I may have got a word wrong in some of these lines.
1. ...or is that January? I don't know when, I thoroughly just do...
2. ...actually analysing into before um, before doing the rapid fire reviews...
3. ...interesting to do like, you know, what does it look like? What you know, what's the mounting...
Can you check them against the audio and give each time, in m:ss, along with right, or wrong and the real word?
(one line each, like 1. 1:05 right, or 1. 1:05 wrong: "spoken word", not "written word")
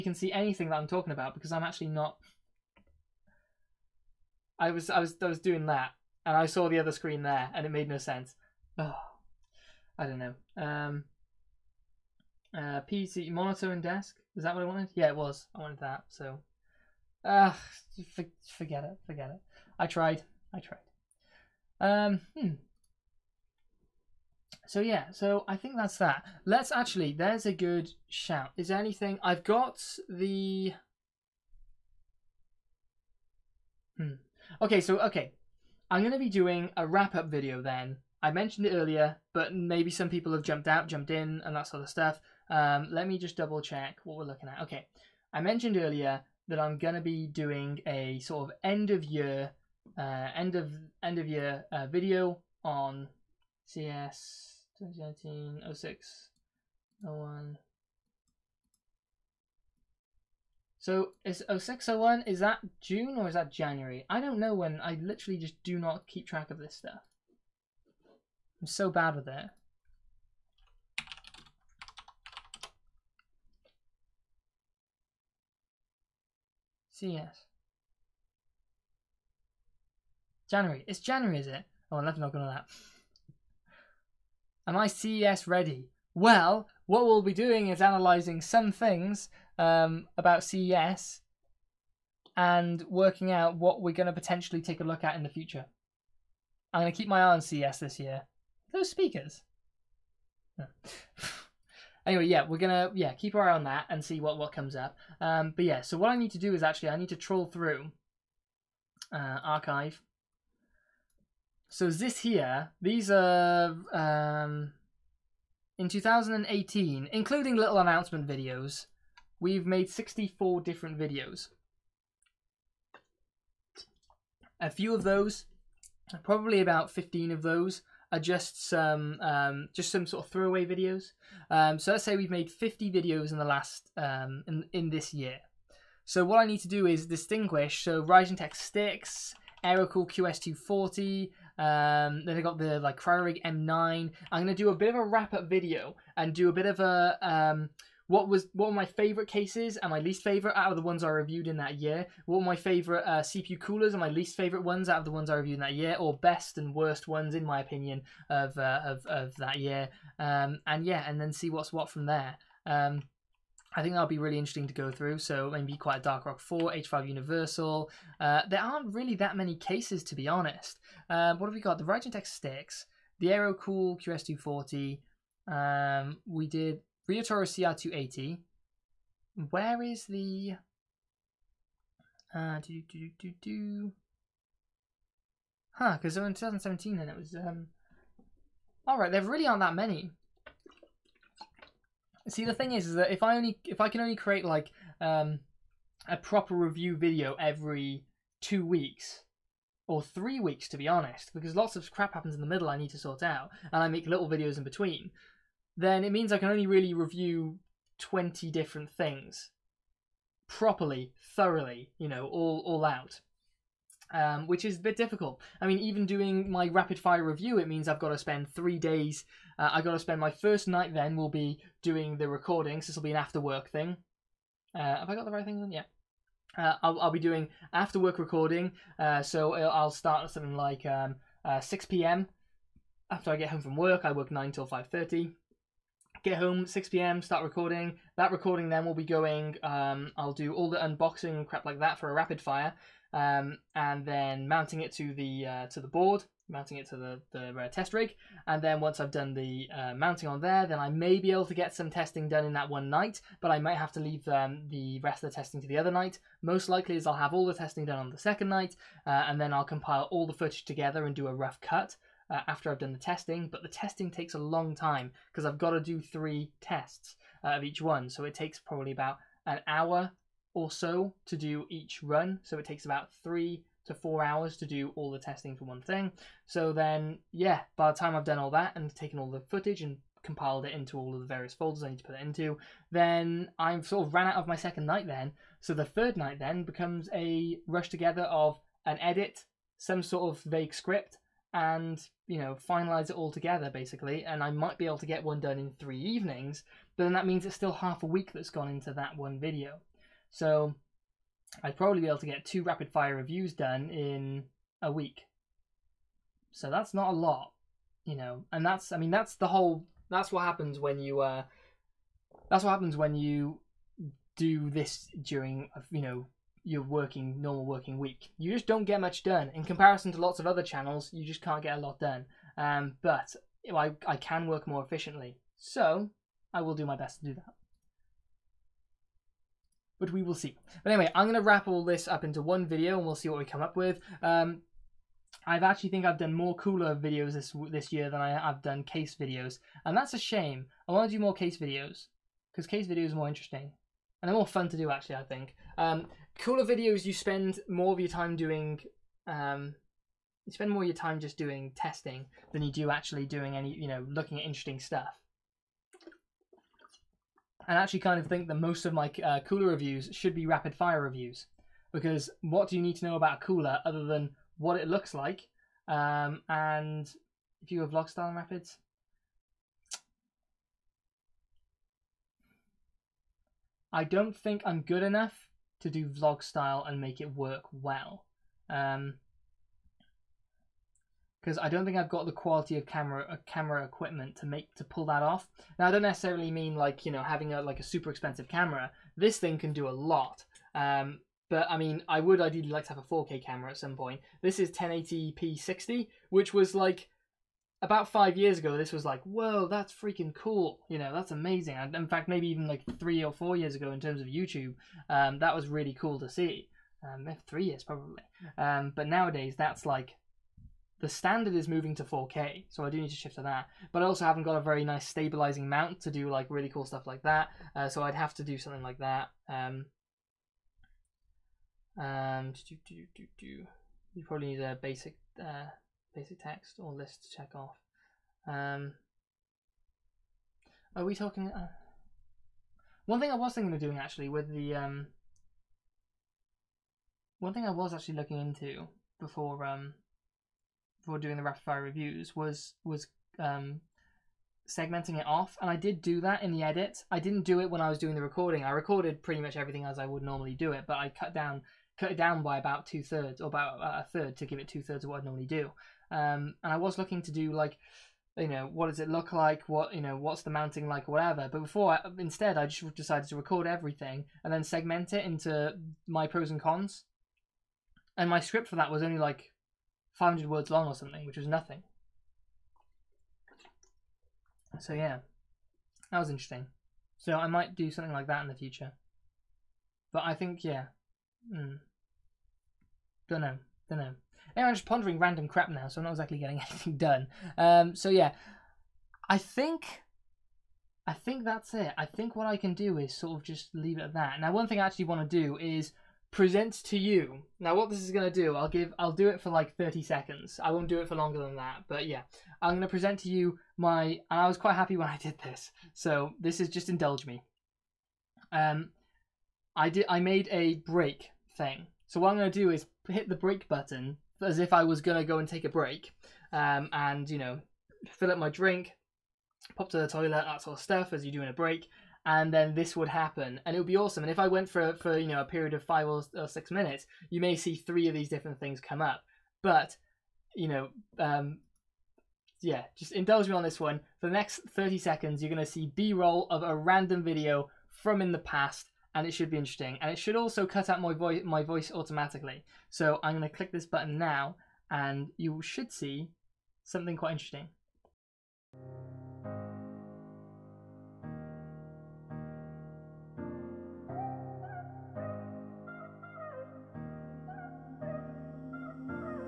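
1. 1:03 wrong: "literally", not "thoroughly"
2. 7:17 wrong: "looking", not "analysing"
3. 7:36 wrong: "looking", not "interesting".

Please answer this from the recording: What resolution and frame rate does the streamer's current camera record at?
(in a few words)
1080p 60.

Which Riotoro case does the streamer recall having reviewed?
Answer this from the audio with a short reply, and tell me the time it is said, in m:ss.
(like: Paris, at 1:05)
CR280, at 2:57.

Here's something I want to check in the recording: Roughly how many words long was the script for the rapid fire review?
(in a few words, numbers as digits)
500.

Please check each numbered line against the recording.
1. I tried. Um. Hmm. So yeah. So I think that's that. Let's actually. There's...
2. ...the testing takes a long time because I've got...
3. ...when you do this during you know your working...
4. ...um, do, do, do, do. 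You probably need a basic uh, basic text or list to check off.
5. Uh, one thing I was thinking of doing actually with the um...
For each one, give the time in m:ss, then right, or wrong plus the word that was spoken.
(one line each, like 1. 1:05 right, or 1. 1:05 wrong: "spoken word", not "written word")
1. 0:20 right
2. 4:23 right
3. 5:12 right
4. 7:01 right
5. 7:11 right.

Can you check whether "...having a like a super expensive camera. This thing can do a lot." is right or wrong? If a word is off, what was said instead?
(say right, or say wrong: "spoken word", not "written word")
right.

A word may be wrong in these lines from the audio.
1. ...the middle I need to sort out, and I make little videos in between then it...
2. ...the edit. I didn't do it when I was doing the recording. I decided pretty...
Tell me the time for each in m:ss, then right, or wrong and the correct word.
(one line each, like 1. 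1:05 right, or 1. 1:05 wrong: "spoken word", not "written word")
1. 3:22 right
2. 7:26 wrong: "recorded", not "decided".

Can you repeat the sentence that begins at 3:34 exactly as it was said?
Um, which is a bit difficult.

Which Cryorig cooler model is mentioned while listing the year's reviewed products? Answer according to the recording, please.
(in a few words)
M9.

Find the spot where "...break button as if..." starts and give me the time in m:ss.
8:33.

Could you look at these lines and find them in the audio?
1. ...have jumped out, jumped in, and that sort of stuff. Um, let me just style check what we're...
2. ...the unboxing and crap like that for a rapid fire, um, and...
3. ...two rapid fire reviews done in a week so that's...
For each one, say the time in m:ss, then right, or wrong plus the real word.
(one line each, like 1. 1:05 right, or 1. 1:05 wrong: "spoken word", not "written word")
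1. 0:40 wrong: "double", not "style"
2. 4:00 right
3. 5:02 right.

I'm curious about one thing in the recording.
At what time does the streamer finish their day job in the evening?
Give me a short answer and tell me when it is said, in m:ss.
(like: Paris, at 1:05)
5:30, at 3:54.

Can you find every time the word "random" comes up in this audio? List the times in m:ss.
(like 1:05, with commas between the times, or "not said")
8:05, 8:56.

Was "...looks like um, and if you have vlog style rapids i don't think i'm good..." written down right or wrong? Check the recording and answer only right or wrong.
right.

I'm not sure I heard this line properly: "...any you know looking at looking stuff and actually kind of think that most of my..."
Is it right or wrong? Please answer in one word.
wrong.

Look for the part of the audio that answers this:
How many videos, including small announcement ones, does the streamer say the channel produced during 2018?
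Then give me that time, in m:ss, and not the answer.
1:59.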